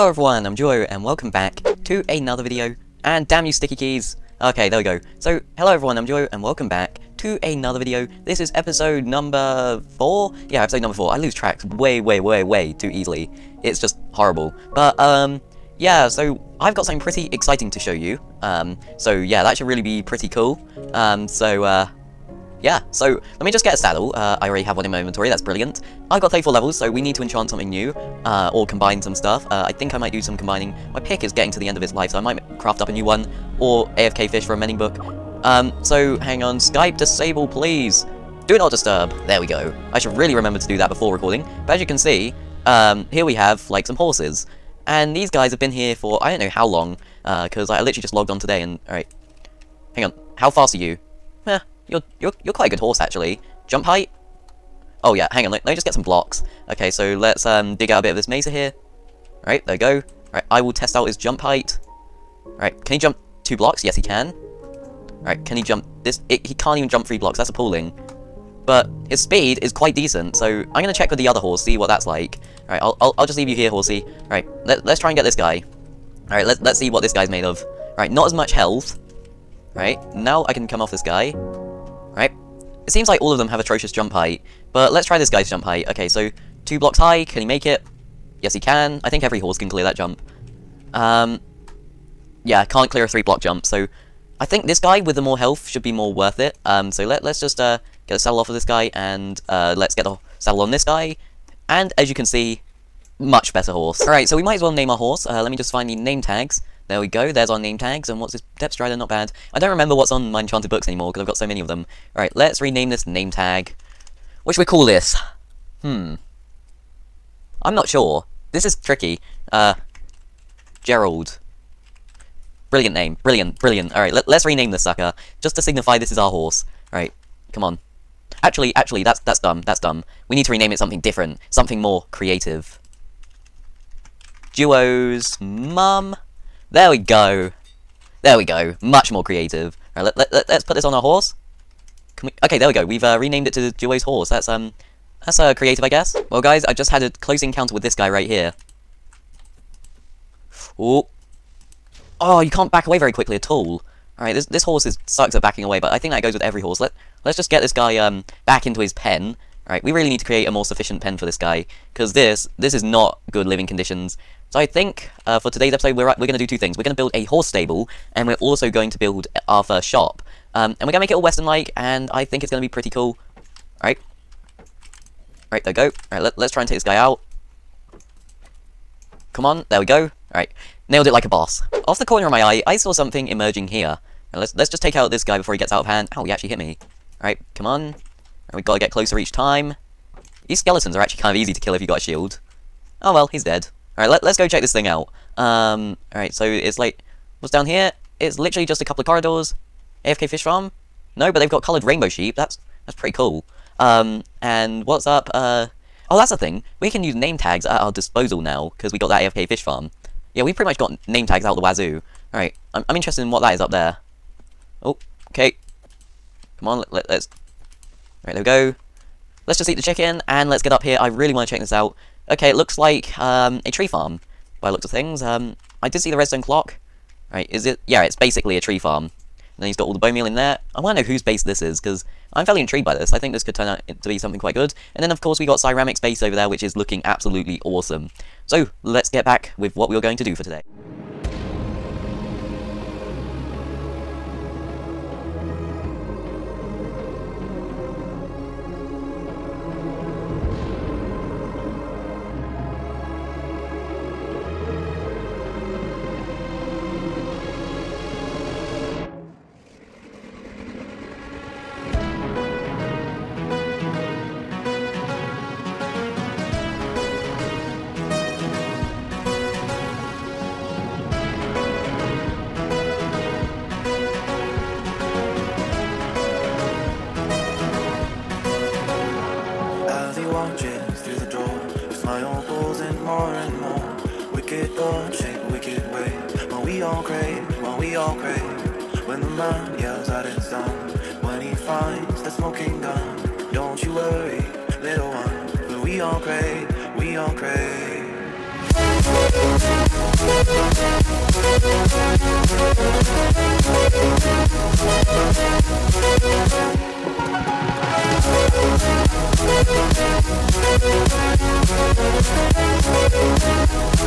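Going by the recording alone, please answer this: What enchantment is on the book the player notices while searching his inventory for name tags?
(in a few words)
Depth Strider.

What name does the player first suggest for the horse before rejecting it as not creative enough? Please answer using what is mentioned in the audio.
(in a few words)
Gerald.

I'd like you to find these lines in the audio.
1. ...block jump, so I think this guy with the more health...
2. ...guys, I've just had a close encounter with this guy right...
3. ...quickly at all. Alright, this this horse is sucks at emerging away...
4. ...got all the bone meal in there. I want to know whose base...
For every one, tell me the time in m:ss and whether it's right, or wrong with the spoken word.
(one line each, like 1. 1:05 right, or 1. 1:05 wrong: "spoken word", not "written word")
1. 1:33 right
2. 2:26 right
3. 2:33 wrong: "backing", not "emerging"
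4. 3:49 right.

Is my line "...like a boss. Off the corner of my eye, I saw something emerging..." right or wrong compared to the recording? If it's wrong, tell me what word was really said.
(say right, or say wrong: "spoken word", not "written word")
right.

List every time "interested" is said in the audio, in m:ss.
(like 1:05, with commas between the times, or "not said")
3:32.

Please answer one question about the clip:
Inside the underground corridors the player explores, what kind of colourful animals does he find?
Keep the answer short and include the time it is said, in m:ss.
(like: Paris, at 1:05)
Rainbow sheep, at 3:21.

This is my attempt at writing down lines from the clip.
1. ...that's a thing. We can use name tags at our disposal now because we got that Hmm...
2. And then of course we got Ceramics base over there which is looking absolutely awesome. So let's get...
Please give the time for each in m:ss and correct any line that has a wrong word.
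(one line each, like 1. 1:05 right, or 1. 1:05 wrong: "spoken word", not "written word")
1. 3:26 wrong: "AFK", not "Hmm"
2. 3:54 right.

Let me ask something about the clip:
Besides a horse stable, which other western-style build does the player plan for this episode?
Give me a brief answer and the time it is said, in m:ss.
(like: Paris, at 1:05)
First shop, at 2:49.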